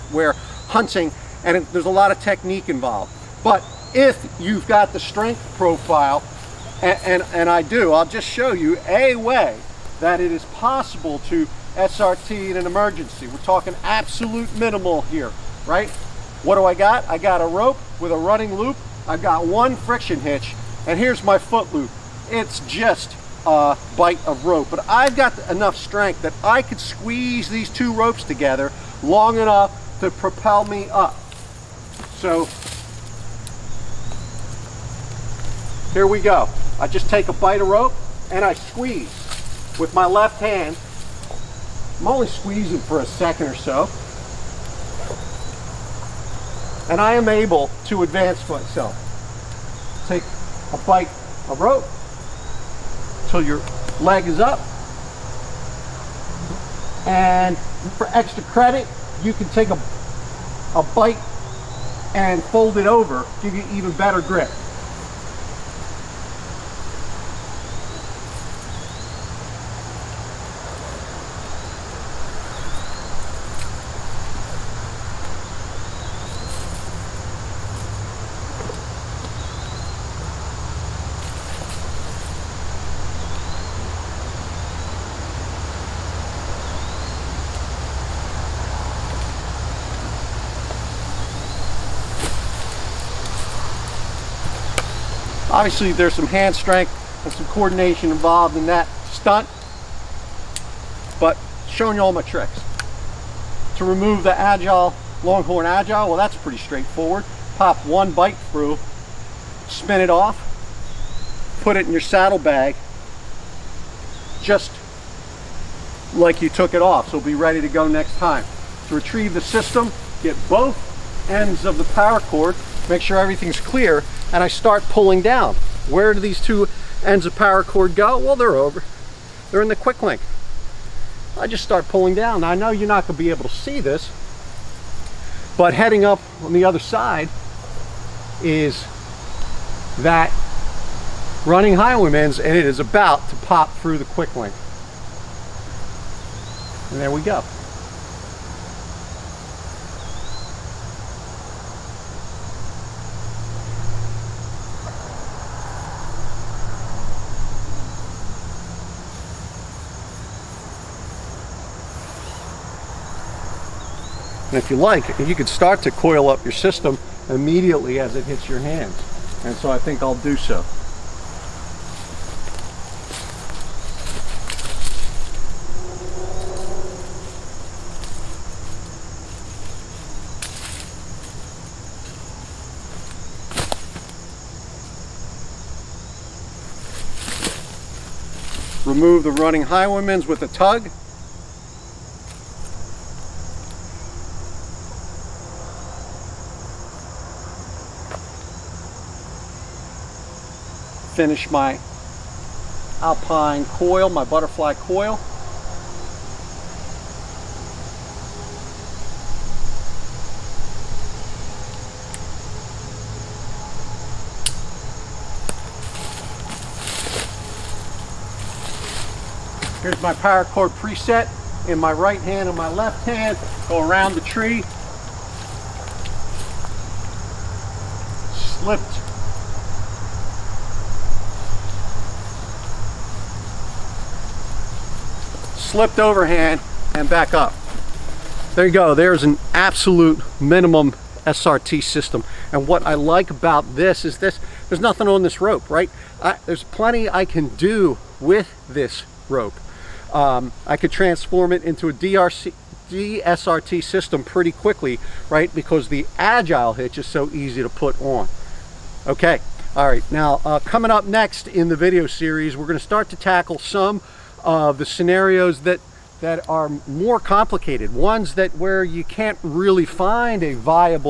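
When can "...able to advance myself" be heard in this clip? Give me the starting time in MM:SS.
00:47.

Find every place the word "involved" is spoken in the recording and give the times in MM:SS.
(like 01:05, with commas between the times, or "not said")
00:02, 01:38.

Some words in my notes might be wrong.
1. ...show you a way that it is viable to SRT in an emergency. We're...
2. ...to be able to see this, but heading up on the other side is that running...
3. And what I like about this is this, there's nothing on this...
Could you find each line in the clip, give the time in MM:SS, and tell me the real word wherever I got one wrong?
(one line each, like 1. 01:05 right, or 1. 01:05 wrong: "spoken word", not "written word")
1. 00:08 wrong: "possible", not "viable"
2. 02:13 right
3. 04:02 right.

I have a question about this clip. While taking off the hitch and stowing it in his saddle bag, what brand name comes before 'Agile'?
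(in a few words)
Longhorn.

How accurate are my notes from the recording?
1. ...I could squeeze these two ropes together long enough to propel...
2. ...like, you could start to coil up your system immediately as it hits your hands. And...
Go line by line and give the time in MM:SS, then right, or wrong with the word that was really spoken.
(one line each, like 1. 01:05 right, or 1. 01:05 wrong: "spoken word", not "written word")
1. 00:26 right
2. 02:44 right.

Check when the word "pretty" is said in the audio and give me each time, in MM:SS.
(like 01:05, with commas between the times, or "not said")
01:46, 04:14.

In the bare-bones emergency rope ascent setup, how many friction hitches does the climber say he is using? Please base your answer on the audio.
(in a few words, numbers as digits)
1.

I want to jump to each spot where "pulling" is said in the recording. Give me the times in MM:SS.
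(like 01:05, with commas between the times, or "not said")
02:04, 02:11.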